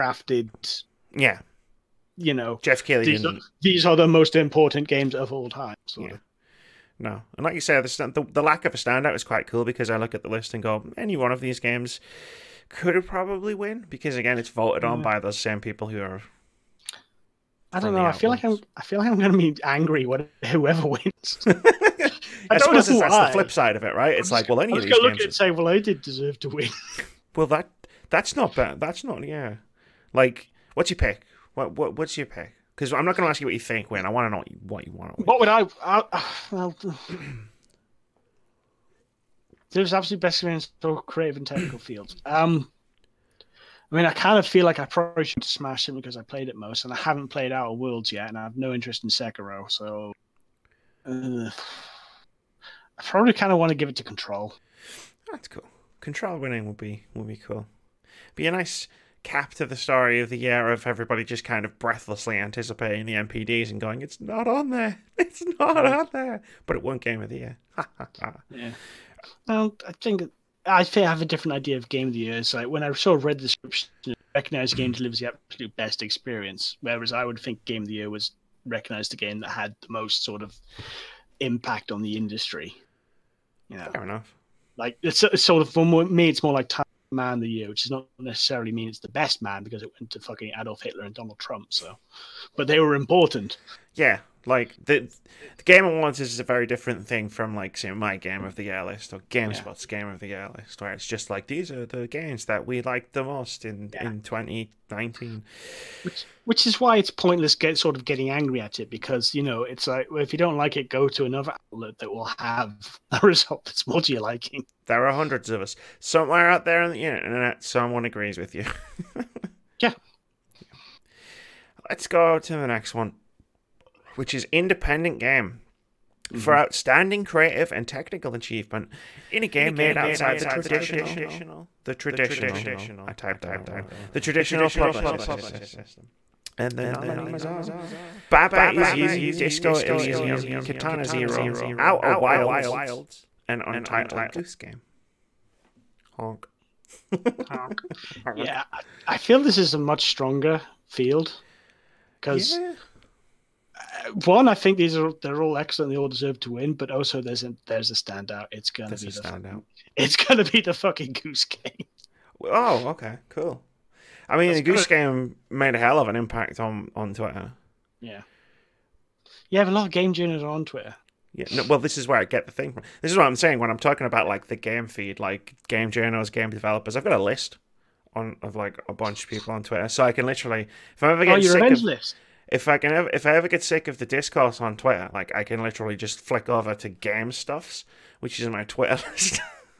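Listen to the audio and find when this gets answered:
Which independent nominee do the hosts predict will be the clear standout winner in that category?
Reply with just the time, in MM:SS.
02:39.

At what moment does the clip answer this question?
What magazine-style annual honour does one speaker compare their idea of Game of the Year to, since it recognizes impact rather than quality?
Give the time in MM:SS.
01:26.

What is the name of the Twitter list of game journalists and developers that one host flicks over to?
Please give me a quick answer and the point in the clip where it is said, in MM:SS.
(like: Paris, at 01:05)
Game Stuffs, at 03:06.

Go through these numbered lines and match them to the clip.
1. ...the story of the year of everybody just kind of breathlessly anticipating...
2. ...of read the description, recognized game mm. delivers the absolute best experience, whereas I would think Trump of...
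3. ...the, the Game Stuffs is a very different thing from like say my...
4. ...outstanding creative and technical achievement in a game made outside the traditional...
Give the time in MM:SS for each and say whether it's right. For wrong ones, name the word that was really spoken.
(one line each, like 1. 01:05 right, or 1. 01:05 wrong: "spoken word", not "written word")
1. 00:59 right
2. 01:13 wrong: "Game", not "Trump"
3. 01:34 wrong: "Awards", not "Stuffs"
4. 02:06 right.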